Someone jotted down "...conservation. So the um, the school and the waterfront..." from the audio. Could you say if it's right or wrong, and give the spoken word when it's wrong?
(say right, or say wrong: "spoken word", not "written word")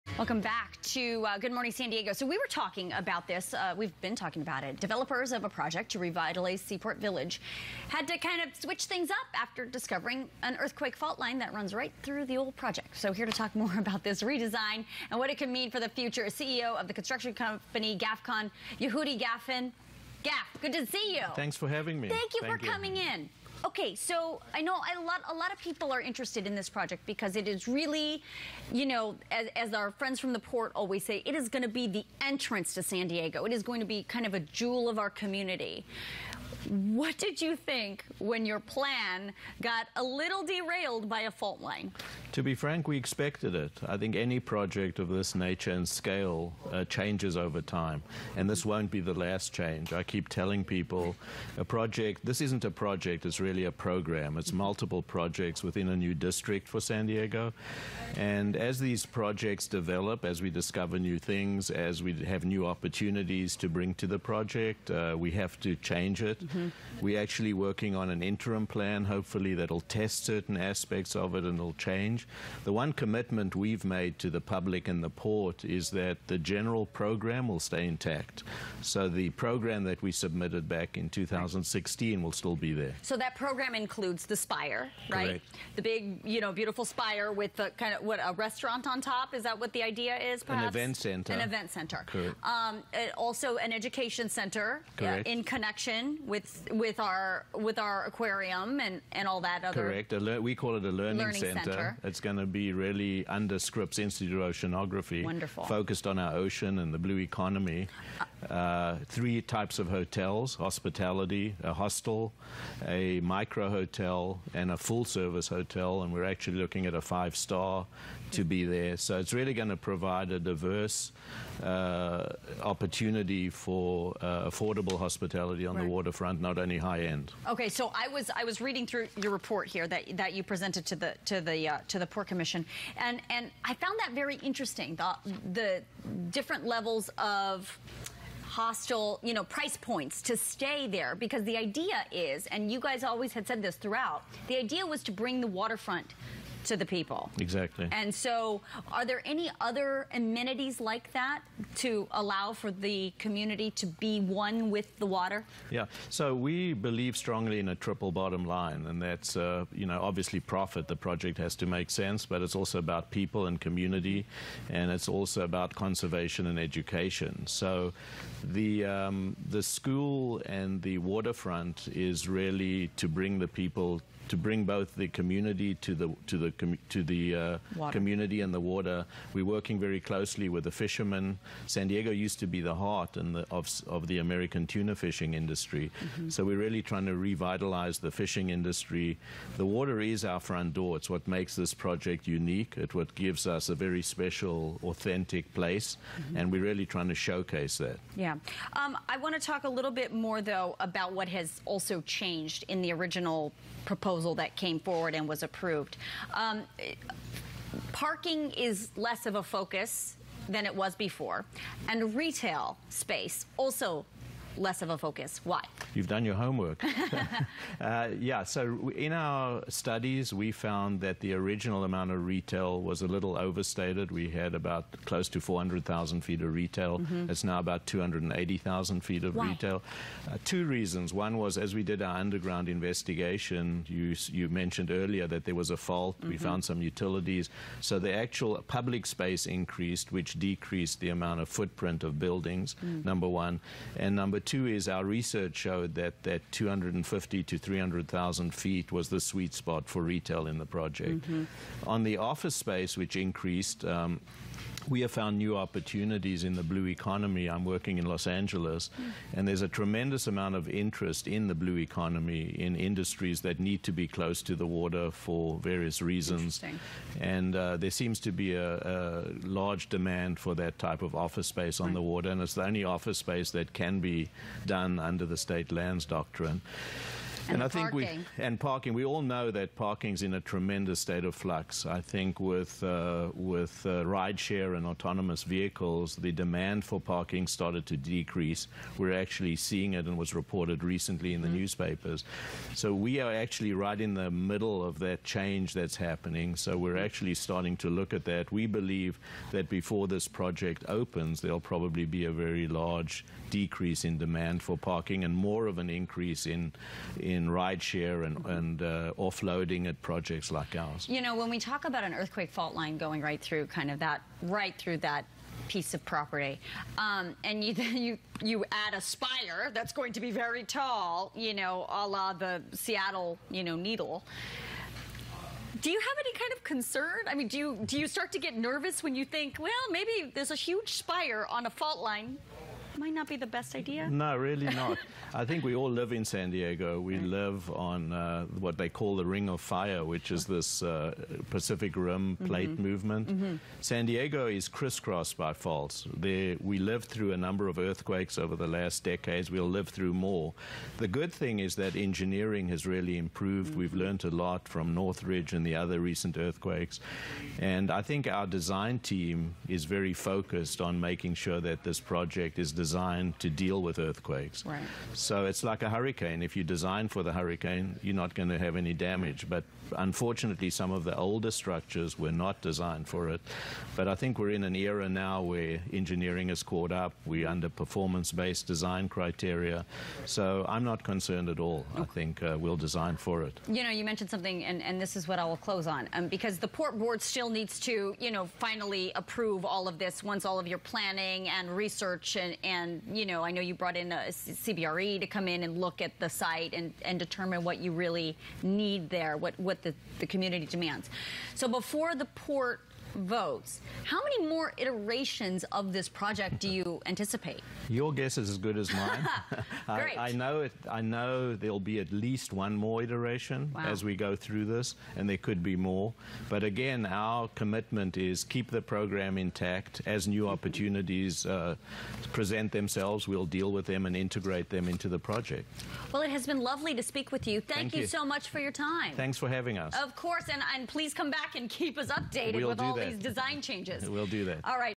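wrong: "education", not "conservation".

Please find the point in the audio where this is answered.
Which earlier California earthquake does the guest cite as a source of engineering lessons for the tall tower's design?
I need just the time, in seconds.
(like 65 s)
354 s.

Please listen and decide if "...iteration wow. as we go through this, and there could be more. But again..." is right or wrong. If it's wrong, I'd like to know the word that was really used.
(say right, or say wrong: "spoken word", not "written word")
right.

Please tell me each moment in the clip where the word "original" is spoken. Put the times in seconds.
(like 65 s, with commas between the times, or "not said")
202 s, 221 s.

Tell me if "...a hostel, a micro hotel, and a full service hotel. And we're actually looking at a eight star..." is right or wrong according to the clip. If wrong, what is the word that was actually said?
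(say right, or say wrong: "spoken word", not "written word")
wrong: "five", not "eight".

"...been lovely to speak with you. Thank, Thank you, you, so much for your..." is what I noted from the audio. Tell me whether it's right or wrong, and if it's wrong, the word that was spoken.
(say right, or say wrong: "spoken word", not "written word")
right.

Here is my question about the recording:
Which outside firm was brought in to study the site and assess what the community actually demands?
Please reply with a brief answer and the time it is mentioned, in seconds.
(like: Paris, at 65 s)
CBRE, at 394 s.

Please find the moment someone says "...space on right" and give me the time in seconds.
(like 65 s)
271 s.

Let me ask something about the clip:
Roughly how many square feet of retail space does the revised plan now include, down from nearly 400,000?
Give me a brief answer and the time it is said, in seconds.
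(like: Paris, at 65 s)
280,000 square feet, at 227 s.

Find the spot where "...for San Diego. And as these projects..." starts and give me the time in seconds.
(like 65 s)
56 s.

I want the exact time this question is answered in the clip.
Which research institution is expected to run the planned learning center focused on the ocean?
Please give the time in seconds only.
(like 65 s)
103 s.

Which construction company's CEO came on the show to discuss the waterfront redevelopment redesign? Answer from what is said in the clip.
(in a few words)
GAFCON.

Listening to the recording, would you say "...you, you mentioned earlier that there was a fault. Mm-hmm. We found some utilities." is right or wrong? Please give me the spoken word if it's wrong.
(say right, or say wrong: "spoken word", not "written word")
right.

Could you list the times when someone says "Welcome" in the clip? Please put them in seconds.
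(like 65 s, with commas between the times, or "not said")
0 s.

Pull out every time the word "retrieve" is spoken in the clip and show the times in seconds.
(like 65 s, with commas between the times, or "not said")
not said.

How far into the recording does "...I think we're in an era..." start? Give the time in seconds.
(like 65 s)
374 s.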